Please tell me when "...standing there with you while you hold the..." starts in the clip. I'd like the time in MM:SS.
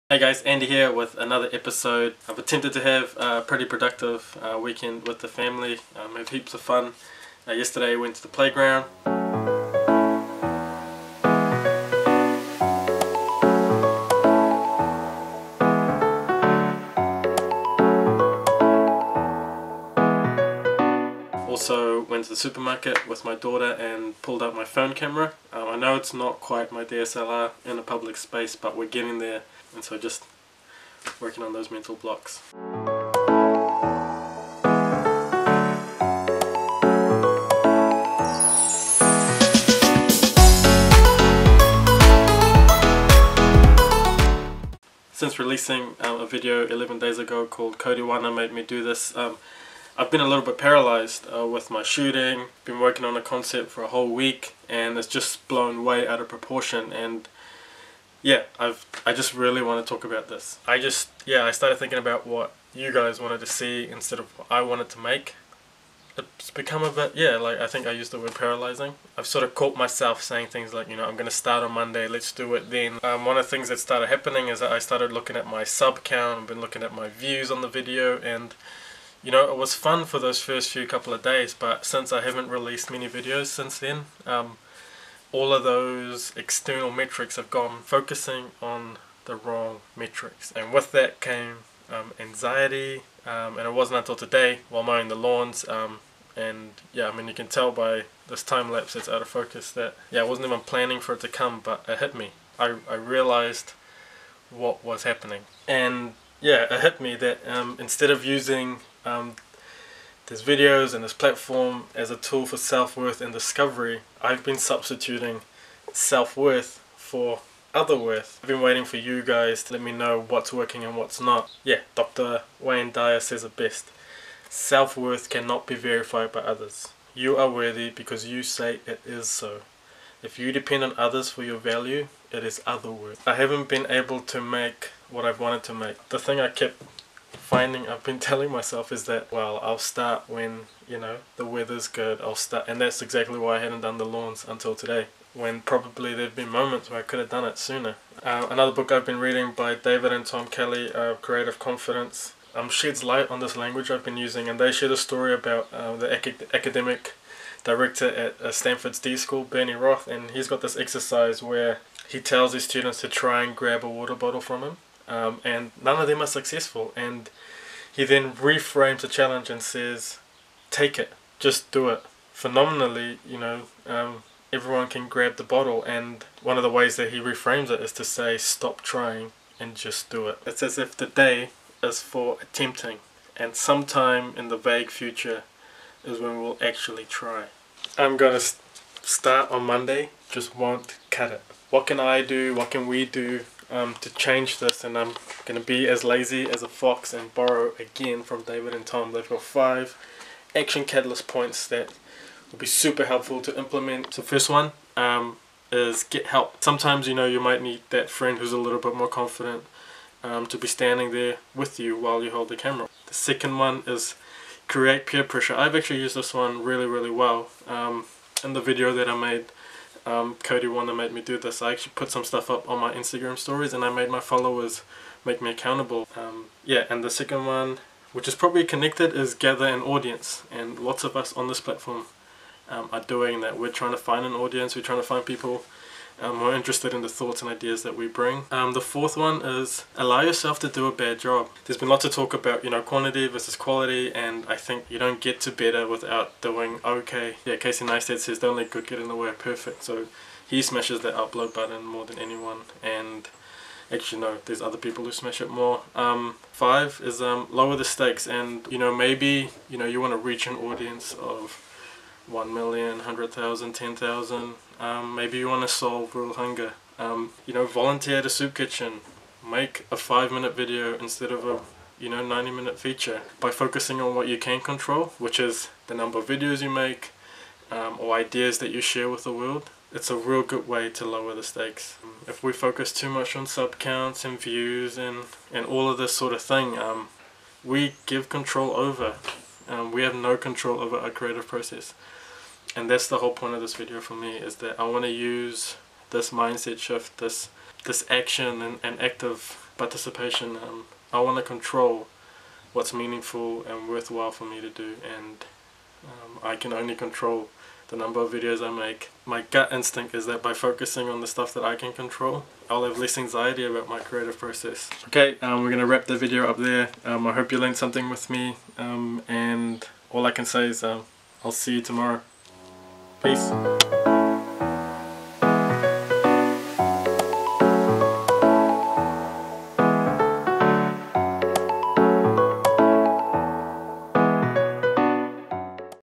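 03:30.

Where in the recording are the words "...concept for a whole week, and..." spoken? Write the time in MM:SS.
00:53.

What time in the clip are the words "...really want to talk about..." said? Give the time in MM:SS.
00:59.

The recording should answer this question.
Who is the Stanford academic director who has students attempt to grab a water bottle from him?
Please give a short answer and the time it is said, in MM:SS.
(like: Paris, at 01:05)
Bernie Roth, at 02:39.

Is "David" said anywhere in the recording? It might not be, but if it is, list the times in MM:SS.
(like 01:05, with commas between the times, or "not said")
02:29, 03:18.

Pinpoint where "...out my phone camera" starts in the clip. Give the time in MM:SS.
00:24.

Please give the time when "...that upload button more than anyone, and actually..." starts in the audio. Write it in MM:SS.
04:11.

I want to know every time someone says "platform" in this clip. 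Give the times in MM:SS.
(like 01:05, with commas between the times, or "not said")
01:51, 03:51.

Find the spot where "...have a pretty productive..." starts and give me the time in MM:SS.
00:02.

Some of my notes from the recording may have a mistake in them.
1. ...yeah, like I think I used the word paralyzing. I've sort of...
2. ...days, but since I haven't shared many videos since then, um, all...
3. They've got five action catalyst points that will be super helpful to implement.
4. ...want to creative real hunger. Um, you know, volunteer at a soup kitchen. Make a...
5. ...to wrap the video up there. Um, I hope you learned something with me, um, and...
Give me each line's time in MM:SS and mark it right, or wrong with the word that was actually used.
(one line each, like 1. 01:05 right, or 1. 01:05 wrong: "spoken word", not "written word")
1. 01:07 right
2. 01:21 wrong: "released", not "shared"
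3. 03:19 right
4. 04:25 wrong: "solve", not "creative"
5. 05:15 right.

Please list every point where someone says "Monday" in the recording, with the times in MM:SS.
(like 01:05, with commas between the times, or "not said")
01:11, 03:09.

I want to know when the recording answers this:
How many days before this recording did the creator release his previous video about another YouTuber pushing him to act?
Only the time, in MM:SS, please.
00:46.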